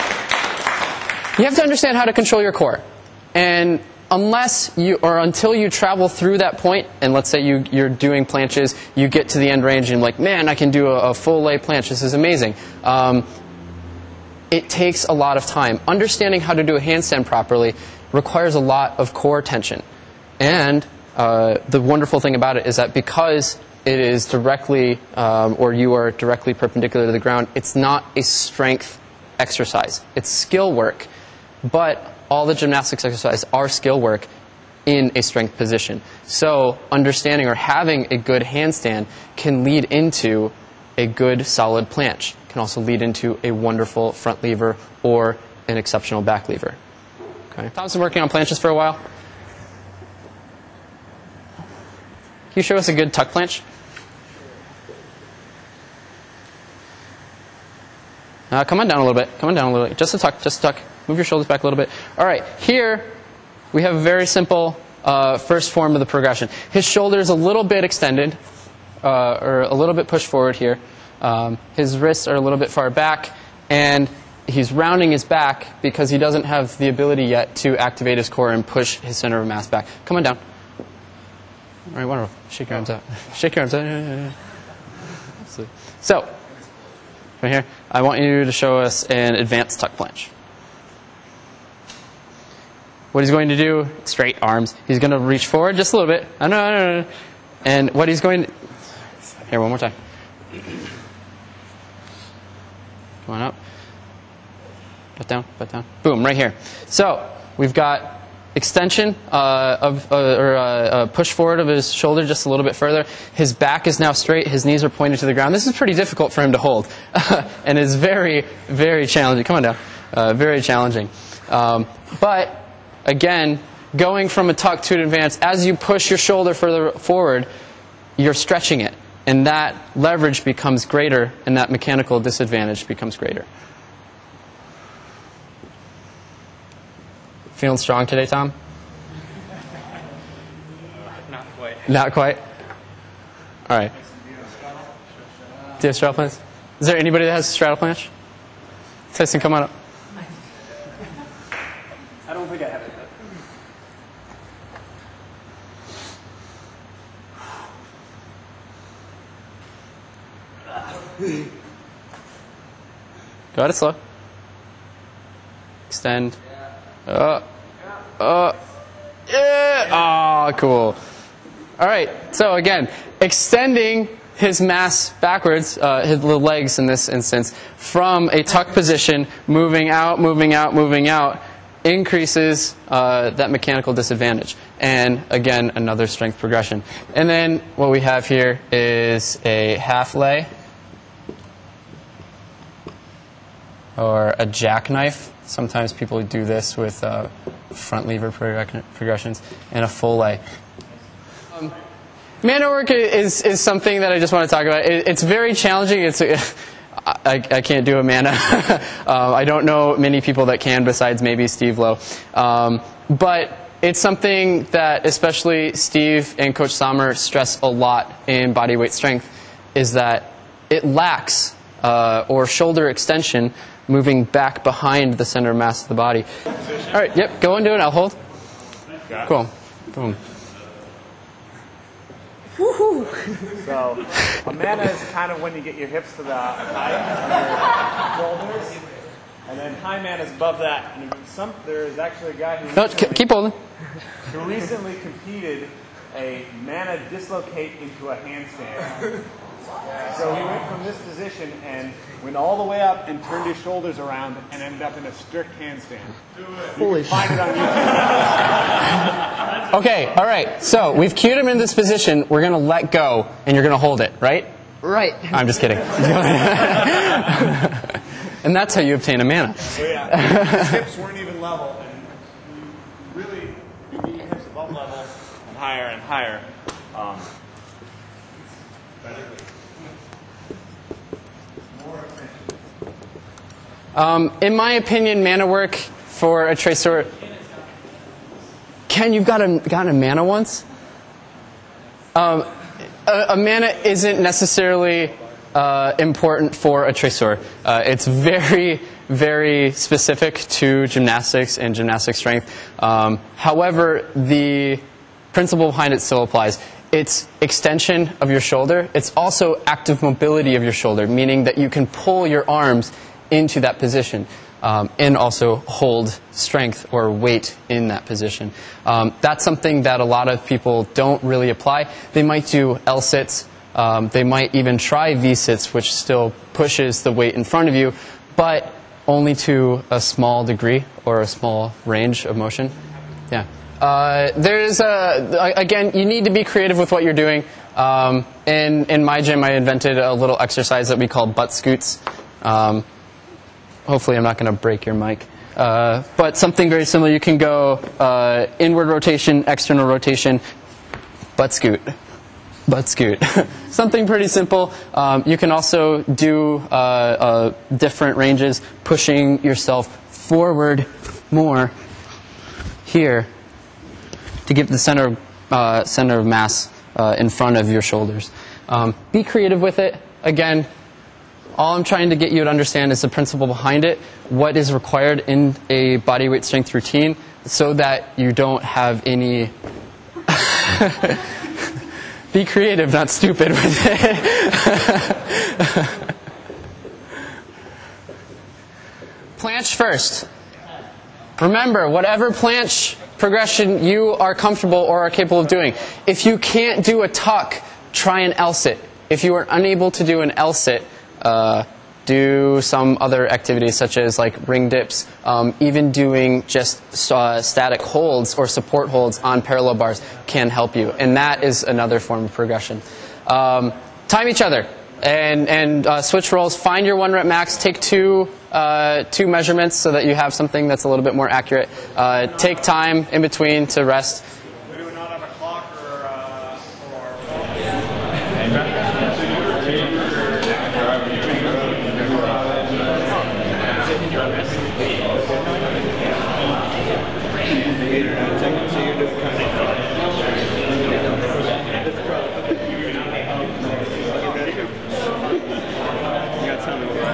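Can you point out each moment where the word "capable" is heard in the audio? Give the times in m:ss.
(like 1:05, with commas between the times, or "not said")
6:35.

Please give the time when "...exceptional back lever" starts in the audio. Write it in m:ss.
0:45.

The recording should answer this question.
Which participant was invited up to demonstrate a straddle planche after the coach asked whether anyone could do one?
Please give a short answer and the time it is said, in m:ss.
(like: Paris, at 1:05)
Tyson, at 2:29.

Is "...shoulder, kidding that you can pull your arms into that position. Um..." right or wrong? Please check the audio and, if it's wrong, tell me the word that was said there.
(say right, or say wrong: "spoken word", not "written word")
wrong: "meaning", not "kidding".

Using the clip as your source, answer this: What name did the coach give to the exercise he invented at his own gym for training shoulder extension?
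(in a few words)
butt scoots.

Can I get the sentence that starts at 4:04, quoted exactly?
Who recently competed a manna dislocate into a handstand.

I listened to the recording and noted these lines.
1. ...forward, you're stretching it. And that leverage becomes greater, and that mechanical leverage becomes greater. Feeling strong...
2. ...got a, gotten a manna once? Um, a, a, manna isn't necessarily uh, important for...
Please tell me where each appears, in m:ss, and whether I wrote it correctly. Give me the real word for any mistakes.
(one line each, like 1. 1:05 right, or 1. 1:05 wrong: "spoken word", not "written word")
1. 2:06 wrong: "disadvantage", not "leverage"
2. 4:49 right.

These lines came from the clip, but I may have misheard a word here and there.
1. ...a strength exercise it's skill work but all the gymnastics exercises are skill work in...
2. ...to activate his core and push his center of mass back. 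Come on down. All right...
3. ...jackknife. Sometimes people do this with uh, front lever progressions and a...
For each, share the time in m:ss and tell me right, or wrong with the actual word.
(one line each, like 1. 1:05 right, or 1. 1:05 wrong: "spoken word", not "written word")
1. 0:28 right
2. 1:17 right
3. 3:14 right.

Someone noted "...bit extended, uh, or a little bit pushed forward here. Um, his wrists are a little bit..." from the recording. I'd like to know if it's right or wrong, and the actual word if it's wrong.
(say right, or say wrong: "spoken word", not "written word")
right.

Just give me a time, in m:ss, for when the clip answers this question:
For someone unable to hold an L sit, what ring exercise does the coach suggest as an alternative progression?
6:44.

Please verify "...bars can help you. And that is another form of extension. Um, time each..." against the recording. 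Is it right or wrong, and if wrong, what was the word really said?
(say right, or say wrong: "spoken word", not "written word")
wrong: "progression", not "extension".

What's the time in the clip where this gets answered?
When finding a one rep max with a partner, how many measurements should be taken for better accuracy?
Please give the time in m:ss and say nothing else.
6:59.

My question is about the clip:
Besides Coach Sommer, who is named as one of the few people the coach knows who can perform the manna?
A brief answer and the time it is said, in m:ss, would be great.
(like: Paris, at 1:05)
Steve Low, at 3:31.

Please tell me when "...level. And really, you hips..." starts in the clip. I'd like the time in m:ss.
4:31.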